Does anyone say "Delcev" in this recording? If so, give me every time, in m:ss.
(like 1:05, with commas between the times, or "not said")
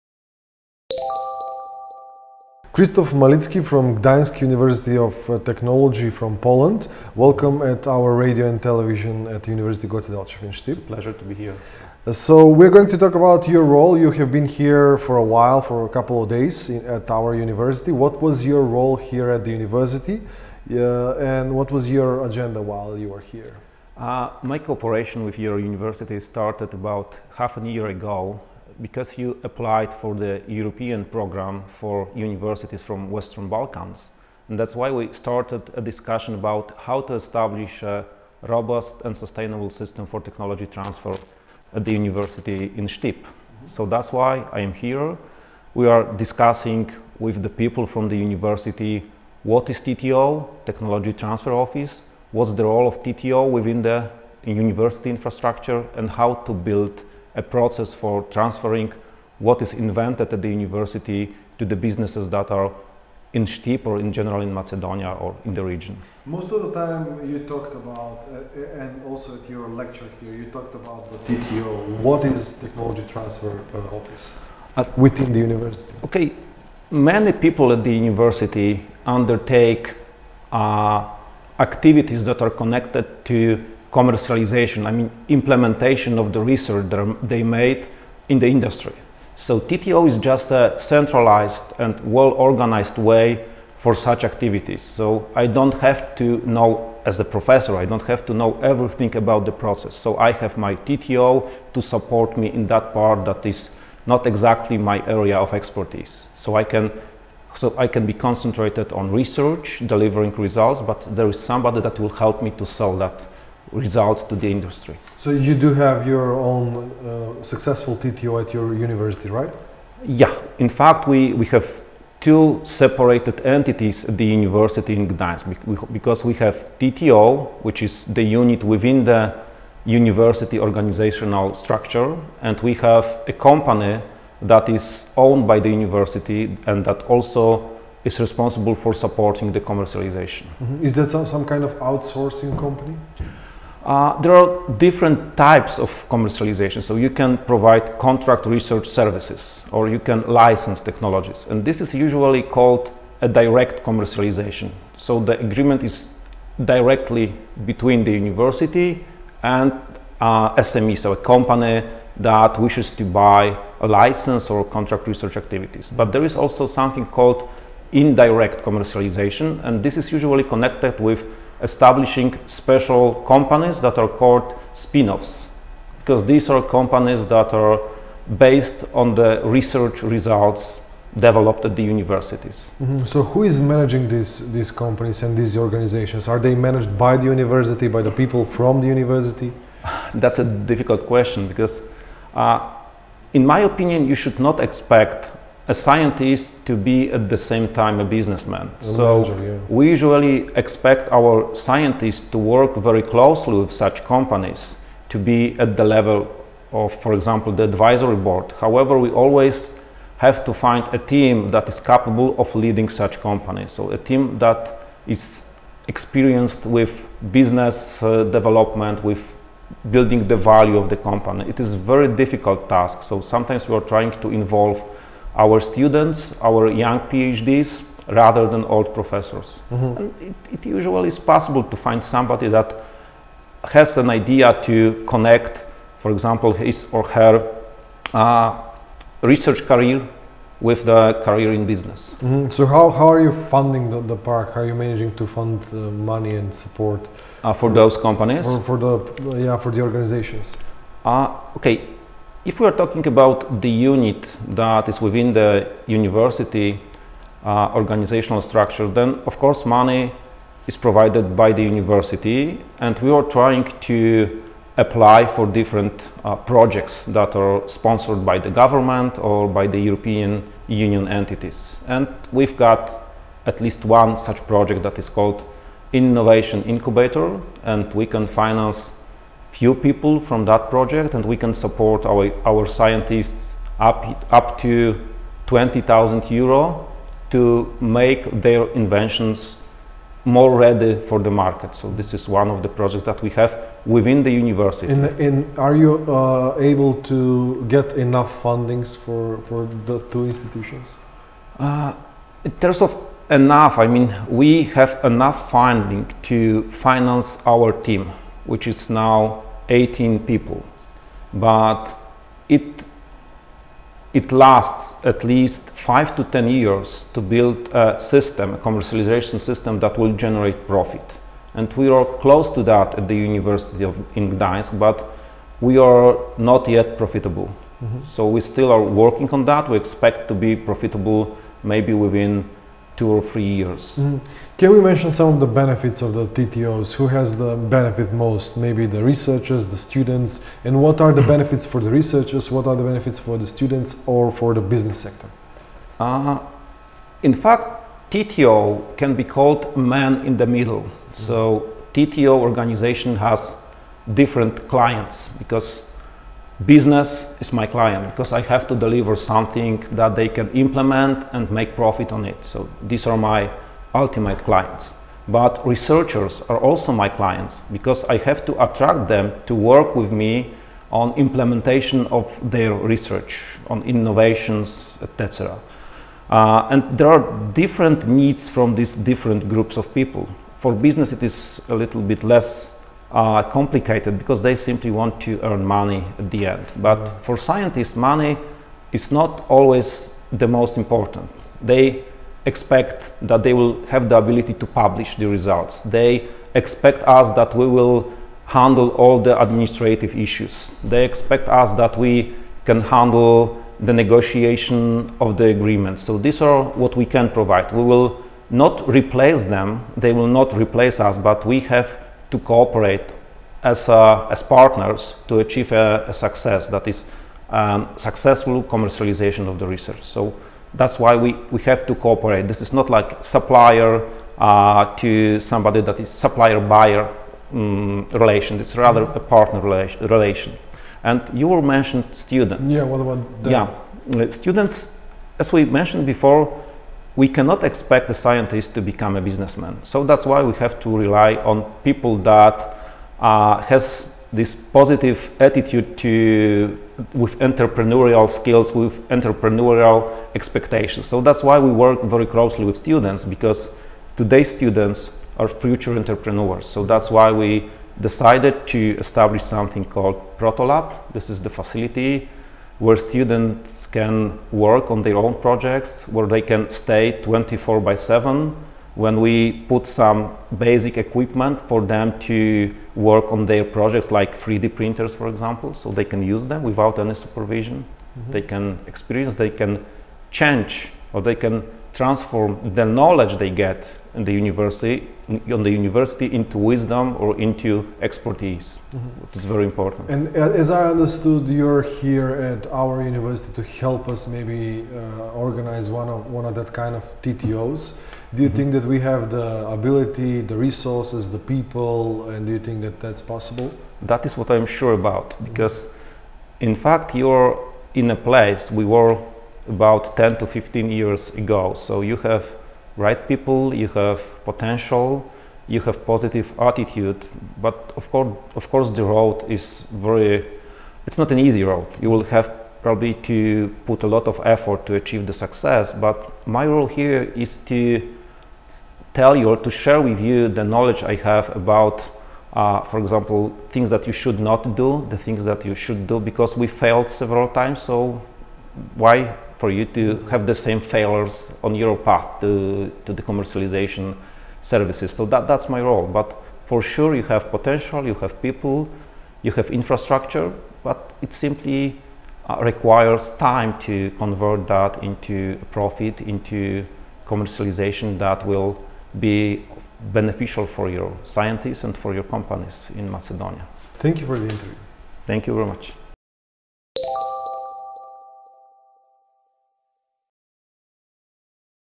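0:10.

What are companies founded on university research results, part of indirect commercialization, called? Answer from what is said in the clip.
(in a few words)
spin-offs.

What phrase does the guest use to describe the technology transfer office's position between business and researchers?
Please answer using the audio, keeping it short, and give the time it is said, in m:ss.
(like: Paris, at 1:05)
man in the middle, at 5:49.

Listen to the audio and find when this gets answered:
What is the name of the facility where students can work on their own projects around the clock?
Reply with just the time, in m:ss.
7:40.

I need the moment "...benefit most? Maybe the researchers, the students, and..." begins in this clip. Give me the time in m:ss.
5:37.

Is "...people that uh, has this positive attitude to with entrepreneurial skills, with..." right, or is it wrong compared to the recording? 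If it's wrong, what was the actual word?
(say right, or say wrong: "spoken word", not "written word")
right.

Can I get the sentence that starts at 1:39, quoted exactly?
So I have my TTO to support me in that part that is not exactly my area of expertise.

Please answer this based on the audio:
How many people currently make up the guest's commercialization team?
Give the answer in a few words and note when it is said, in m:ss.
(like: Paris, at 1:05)
18, at 5:09.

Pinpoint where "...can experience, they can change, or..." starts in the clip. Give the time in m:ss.
7:58.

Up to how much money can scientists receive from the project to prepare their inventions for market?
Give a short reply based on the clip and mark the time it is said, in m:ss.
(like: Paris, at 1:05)
20,000 euro, at 4:45.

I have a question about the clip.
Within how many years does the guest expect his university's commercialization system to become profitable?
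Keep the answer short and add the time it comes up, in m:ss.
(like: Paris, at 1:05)
2 or 3, at 5:33.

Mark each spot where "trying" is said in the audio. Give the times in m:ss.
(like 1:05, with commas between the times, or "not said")
3:43, 4:23.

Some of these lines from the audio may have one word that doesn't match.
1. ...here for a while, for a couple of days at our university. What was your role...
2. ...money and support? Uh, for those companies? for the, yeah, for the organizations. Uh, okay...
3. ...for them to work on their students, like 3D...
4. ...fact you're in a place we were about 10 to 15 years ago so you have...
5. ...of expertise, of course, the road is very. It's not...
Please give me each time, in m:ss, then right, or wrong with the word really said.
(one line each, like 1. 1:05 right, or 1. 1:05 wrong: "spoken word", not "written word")
1. 0:14 right
2. 4:06 right
3. 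7:51 wrong: "projects", not "students"
4. 8:26 right
5. 8:37 wrong: "course", not "expertise".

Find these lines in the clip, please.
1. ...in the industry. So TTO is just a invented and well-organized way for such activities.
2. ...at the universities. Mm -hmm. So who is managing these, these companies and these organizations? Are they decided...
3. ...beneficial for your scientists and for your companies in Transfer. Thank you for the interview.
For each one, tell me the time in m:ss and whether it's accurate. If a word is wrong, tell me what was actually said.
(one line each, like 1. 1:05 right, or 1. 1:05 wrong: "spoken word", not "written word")
1. 1:28 wrong: "centralized", not "invented"
2. 3:01 wrong: "managed", not "decided"
3. 9:20 wrong: "Macedonia", not "Transfer".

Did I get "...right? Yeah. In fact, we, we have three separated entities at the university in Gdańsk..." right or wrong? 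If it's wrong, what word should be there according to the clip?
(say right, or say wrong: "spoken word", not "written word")
wrong: "two", not "three".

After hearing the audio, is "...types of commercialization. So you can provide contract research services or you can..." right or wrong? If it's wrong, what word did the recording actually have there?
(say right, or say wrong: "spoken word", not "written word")
right.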